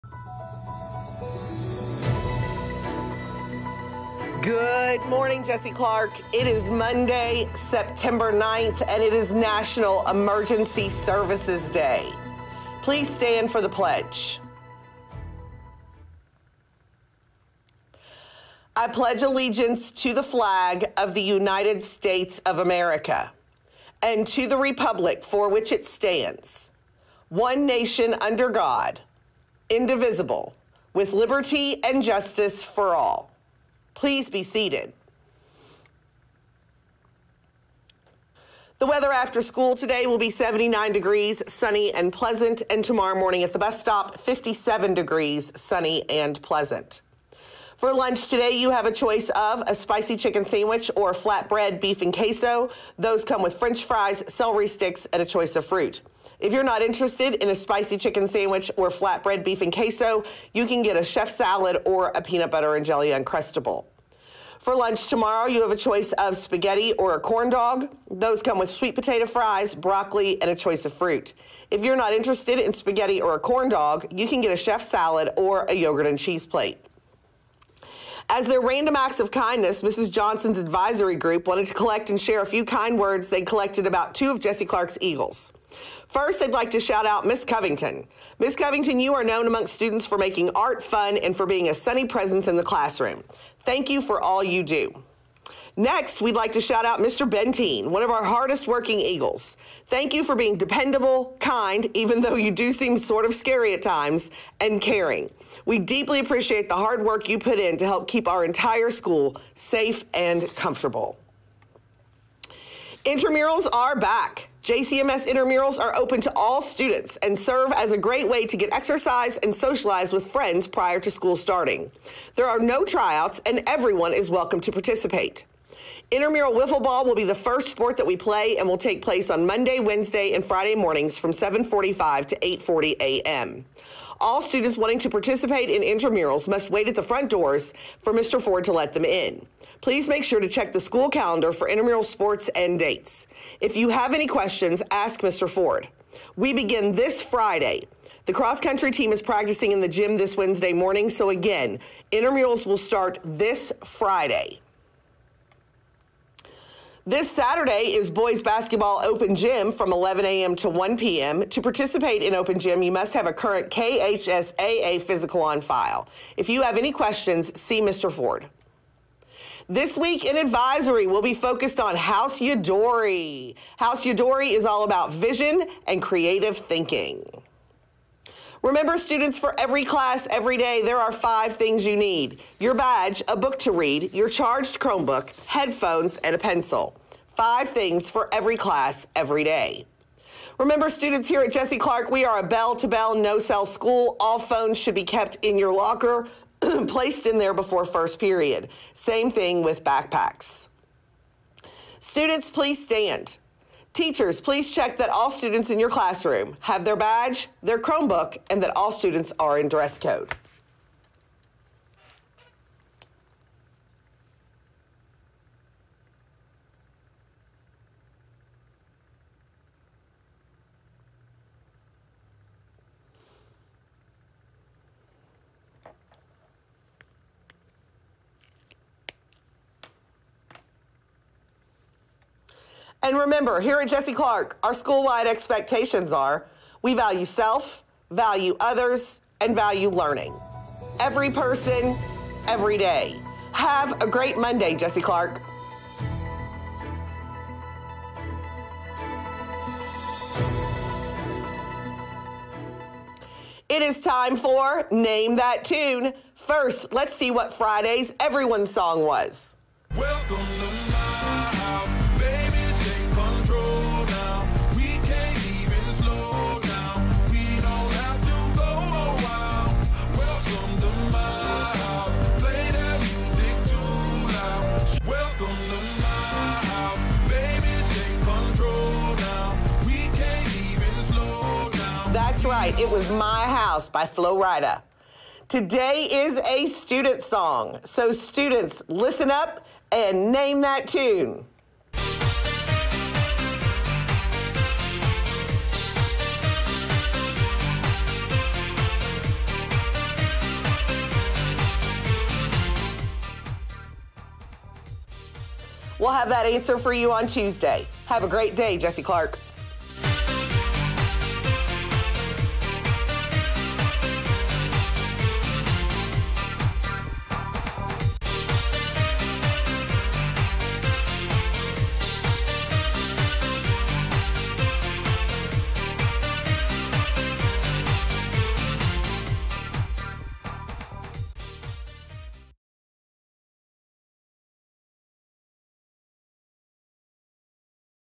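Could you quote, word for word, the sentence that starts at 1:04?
For lunch tomorrow, you have a choice of spaghetti or a corn dog.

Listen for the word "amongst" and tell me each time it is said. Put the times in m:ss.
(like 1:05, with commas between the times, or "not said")
1:29.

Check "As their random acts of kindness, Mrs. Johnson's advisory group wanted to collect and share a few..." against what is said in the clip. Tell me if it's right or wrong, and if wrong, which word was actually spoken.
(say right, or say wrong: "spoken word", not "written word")
right.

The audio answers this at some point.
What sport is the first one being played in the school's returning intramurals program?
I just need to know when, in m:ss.
2:06.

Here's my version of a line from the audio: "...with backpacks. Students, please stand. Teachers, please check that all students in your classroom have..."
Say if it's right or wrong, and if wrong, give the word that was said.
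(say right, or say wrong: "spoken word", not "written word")
right.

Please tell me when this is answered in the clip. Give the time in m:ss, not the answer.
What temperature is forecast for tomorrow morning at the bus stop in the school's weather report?
0:44.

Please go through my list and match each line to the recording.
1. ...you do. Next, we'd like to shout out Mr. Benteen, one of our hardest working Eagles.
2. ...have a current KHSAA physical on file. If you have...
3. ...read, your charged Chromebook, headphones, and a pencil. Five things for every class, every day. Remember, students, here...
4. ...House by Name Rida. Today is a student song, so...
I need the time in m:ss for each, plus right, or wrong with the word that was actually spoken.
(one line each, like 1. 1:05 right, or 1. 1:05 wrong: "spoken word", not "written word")
1. 1:34 right
2. 2:43 right
3. 3:03 right
4. 4:43 wrong: "Flo", not "Name".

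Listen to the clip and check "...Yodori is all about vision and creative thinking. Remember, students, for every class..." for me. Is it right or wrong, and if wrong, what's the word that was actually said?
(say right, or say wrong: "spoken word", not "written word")
right.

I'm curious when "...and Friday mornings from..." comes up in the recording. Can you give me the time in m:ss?
2:10.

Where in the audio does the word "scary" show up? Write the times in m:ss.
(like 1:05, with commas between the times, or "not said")
1:43.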